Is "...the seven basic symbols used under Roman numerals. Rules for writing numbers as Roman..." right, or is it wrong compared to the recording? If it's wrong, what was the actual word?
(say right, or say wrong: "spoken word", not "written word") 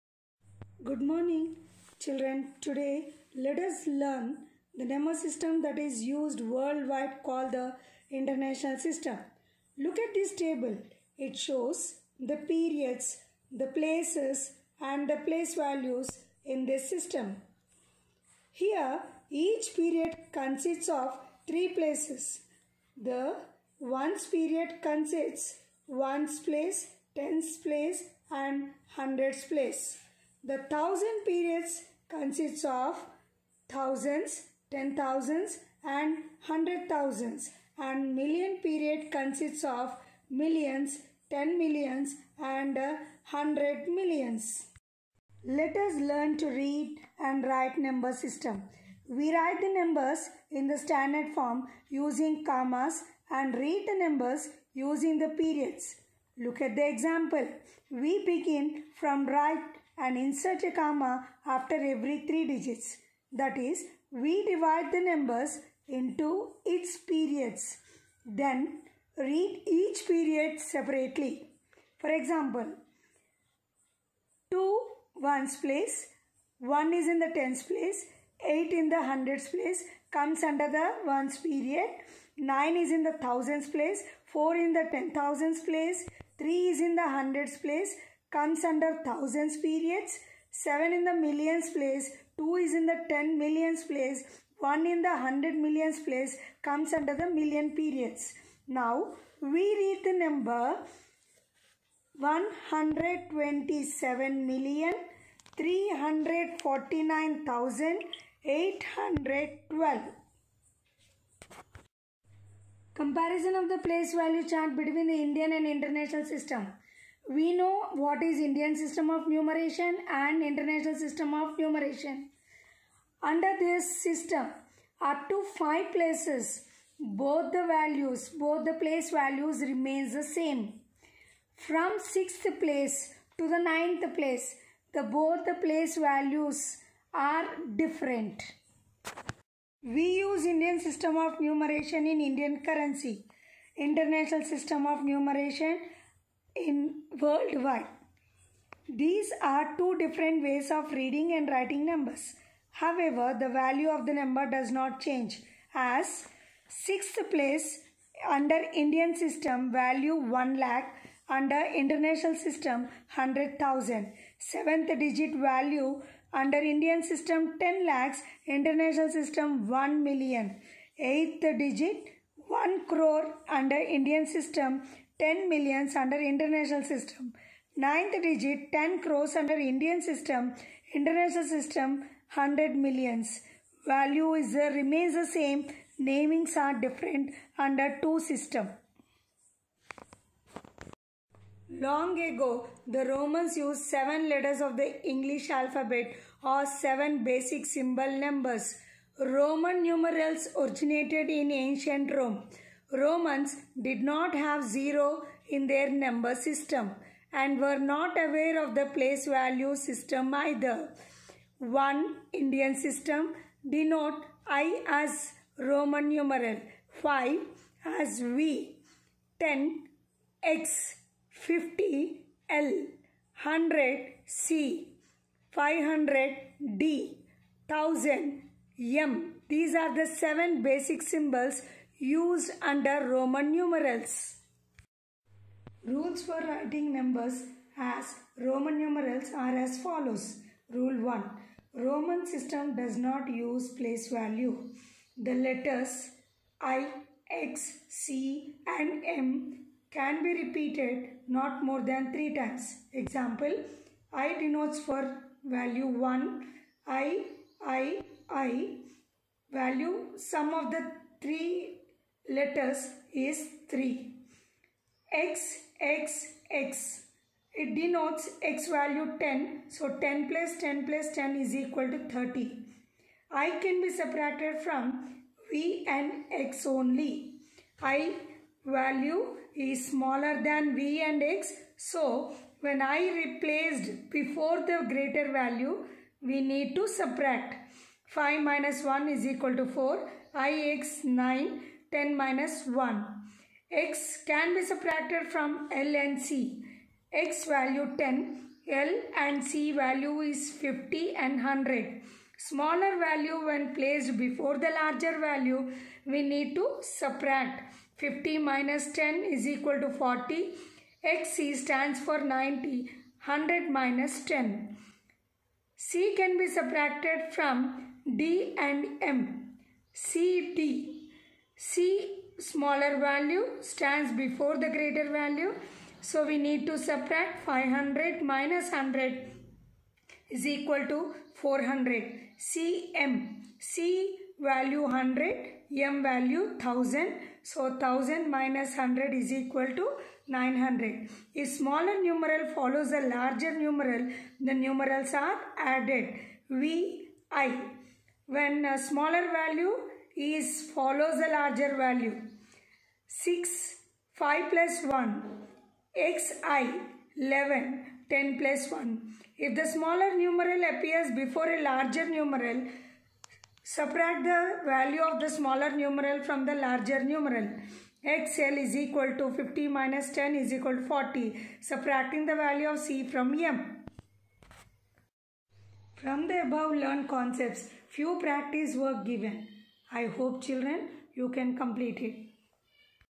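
right.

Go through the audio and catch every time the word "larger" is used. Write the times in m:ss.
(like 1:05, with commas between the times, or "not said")
5:04, 5:43, 5:51, 6:01, 6:06.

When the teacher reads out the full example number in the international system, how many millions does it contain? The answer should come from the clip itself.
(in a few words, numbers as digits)
127 million.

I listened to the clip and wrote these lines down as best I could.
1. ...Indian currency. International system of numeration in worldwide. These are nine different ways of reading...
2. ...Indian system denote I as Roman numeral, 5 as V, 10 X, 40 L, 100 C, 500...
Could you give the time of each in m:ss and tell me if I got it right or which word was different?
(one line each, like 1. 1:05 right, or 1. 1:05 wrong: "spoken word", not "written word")
1. 2:22 wrong: "two", not "nine"
2. 3:32 wrong: "50", not "40".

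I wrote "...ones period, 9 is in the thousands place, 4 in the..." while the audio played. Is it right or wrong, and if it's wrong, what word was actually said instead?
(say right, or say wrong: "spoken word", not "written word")
right.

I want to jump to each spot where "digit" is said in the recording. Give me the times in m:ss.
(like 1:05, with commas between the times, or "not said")
1:02, 2:44, 2:51, 2:58.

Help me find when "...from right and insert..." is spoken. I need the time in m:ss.
0:58.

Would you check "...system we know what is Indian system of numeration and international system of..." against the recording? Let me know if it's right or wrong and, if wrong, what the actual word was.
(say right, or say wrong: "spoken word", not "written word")
right.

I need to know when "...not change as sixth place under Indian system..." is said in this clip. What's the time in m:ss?
2:34.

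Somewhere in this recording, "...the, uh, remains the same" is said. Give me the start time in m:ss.
3:04.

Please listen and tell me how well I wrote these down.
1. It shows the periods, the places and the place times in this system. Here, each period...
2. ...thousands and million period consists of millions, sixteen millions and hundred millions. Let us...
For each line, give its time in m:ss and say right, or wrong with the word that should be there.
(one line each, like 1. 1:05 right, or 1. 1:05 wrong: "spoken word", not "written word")
1. 0:11 wrong: "values", not "times"
2. 0:36 wrong: "ten", not "sixteen".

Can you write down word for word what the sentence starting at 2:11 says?
From 6th place to the ninth place, the both the place values are different.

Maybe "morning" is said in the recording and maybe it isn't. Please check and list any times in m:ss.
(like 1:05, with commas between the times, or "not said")
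0:01.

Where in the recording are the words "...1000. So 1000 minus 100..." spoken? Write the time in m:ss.
5:36.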